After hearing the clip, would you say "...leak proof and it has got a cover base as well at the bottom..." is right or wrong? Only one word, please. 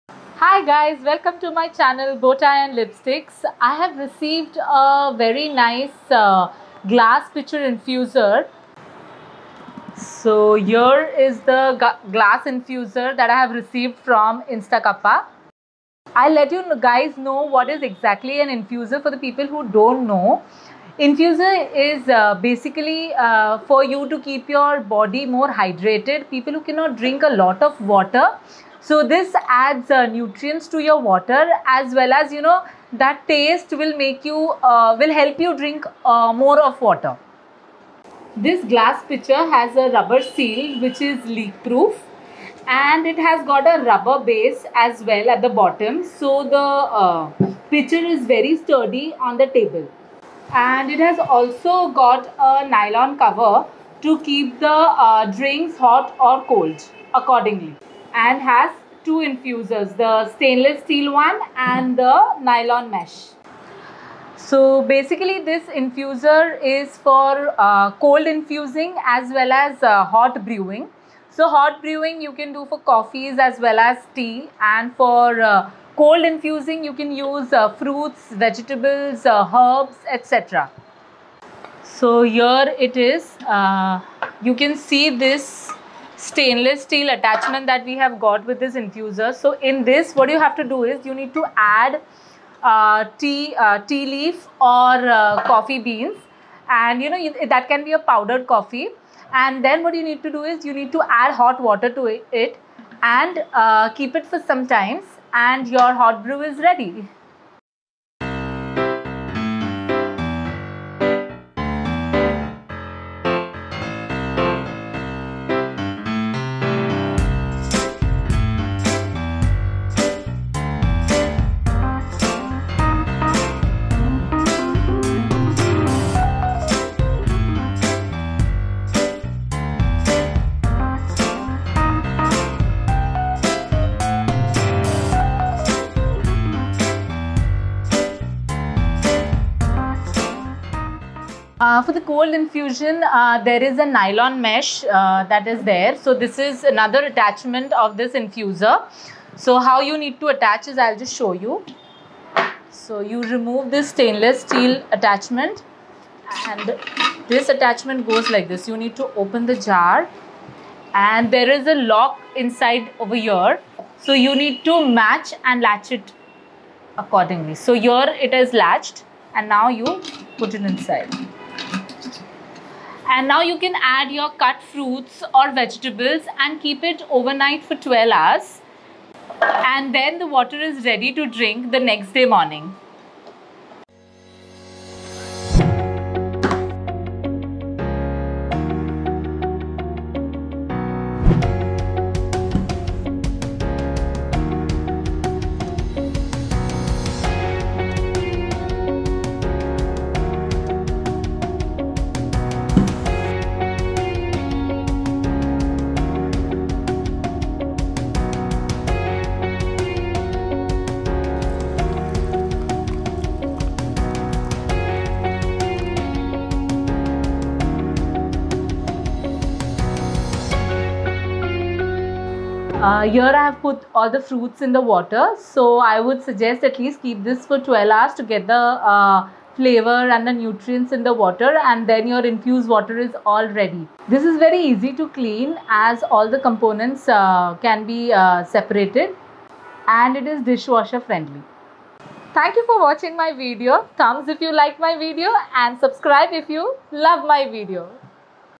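wrong.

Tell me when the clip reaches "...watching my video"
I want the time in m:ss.
4:02.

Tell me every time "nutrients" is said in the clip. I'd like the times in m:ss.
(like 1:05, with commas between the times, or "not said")
0:30, 3:50.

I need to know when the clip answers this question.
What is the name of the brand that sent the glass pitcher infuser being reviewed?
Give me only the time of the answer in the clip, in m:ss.
0:14.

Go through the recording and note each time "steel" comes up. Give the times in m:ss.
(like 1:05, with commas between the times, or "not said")
1:00, 1:26, 2:34.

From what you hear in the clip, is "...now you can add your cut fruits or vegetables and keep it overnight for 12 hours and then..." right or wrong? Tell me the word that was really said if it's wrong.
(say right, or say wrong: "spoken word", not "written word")
right.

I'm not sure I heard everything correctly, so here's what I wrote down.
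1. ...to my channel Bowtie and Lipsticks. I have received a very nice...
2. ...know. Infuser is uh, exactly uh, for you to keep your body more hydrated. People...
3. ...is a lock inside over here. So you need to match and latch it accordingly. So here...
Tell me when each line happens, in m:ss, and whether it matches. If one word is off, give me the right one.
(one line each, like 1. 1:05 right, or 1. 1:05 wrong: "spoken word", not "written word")
1. 0:01 right
2. 0:20 wrong: "basically", not "exactly"
3. 2:41 right.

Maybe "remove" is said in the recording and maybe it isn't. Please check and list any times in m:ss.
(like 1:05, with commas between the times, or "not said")
2:33.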